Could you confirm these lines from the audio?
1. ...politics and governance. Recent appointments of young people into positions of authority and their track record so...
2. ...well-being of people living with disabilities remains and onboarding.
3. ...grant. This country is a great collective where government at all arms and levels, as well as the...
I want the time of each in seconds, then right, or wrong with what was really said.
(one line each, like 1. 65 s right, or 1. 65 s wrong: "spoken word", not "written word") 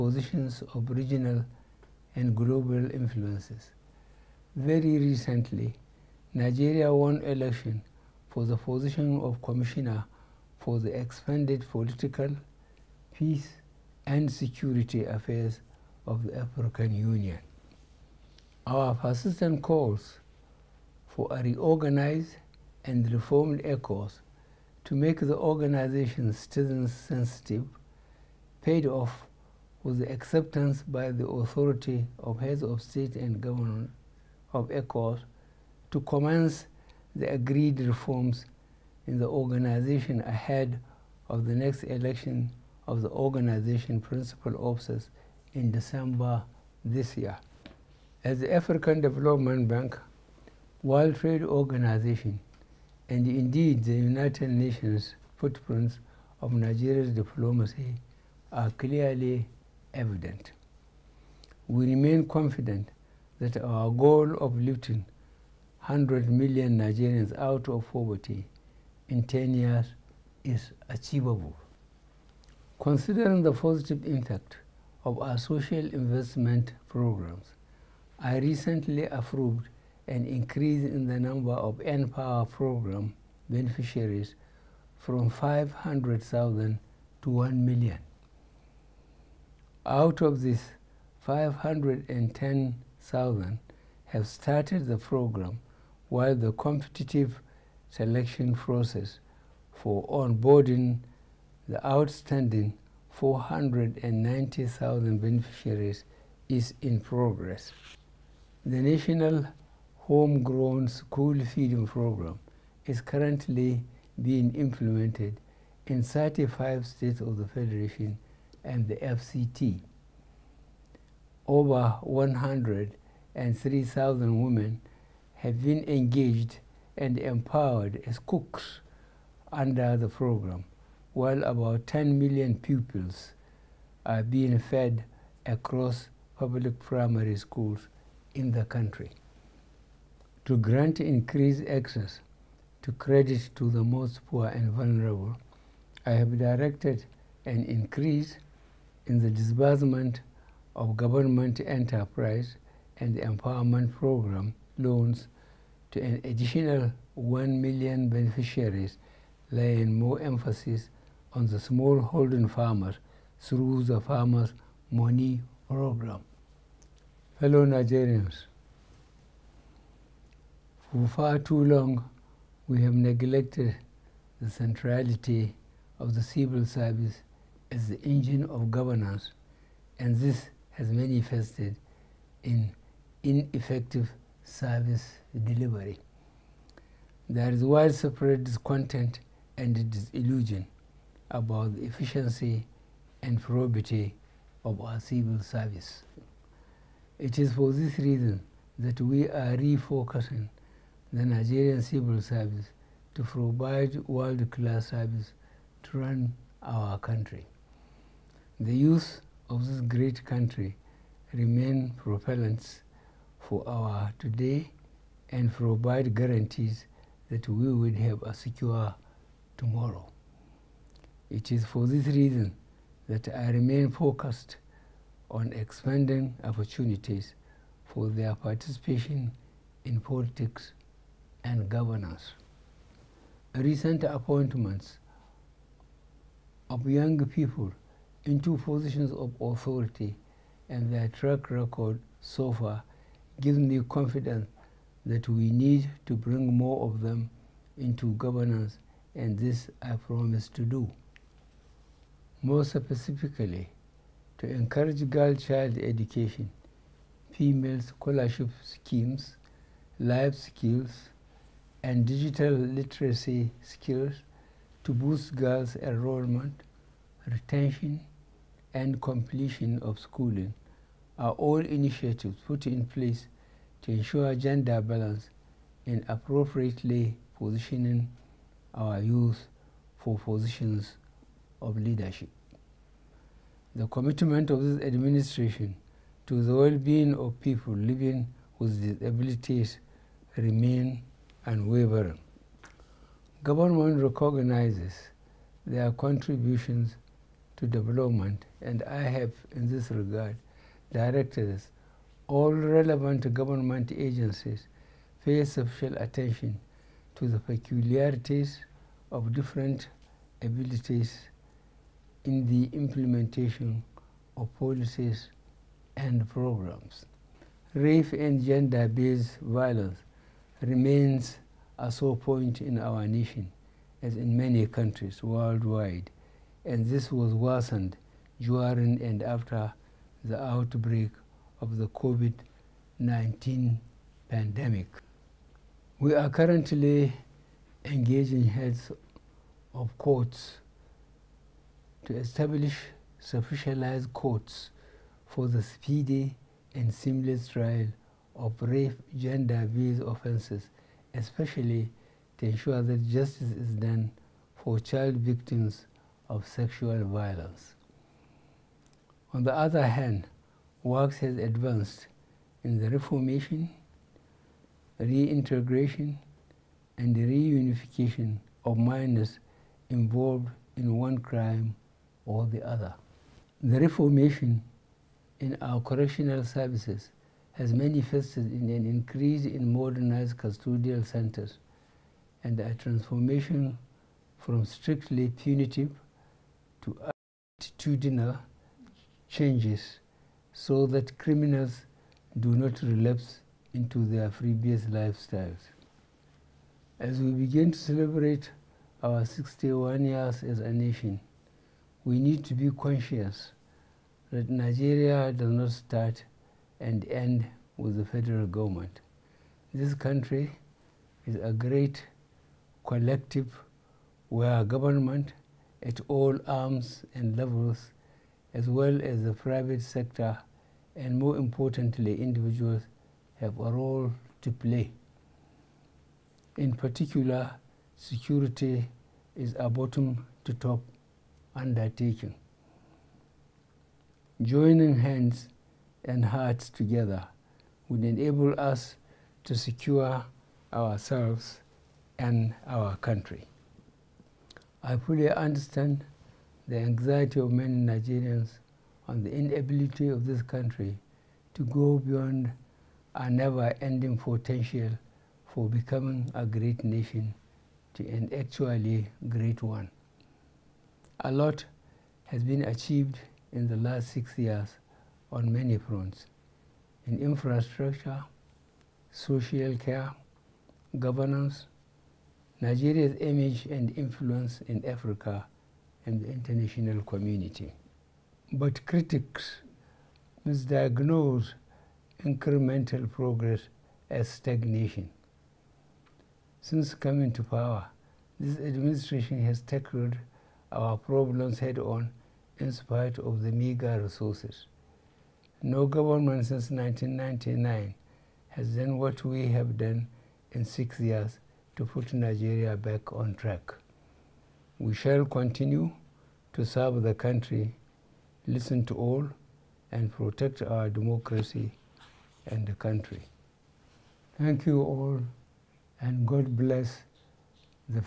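1. 229 s right
2. 286 s wrong: "wavering", not "onboarding"
3. 408 s wrong: "government", not "grant".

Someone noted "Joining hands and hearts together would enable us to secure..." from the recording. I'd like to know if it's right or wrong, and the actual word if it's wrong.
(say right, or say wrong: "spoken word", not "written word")
right.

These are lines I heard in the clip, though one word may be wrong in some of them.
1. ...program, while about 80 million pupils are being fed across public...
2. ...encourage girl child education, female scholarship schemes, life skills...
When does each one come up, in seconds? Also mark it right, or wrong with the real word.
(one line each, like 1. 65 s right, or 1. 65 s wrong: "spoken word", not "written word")
1. 130 s wrong: "10", not "80"
2. 254 s right.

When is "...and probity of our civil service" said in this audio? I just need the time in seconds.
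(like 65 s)
193 s.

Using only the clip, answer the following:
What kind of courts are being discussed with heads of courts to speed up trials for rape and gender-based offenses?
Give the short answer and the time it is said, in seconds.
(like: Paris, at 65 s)
Specialized courts, at 343 s.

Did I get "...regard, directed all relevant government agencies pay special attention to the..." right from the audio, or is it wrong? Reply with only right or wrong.
right.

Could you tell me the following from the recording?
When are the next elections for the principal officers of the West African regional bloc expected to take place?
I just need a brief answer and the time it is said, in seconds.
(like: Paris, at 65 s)
December, at 45 s.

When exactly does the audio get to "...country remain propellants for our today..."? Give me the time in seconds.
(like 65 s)
210 s.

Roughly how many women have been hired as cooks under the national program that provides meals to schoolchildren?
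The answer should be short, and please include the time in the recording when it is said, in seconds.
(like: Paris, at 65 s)
103,000, at 122 s.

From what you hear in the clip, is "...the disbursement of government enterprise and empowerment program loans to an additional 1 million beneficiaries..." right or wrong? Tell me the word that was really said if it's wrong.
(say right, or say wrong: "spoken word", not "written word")
right.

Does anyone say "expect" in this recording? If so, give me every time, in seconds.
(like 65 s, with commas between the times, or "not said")
not said.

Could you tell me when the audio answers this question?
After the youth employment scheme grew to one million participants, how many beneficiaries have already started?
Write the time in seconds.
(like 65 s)
91 s.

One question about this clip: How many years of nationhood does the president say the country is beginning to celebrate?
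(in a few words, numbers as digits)
61.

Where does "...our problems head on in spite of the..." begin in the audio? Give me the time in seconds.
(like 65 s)
490 s.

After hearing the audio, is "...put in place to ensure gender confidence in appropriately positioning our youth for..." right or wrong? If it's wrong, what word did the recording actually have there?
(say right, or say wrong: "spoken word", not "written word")
wrong: "balance", not "confidence".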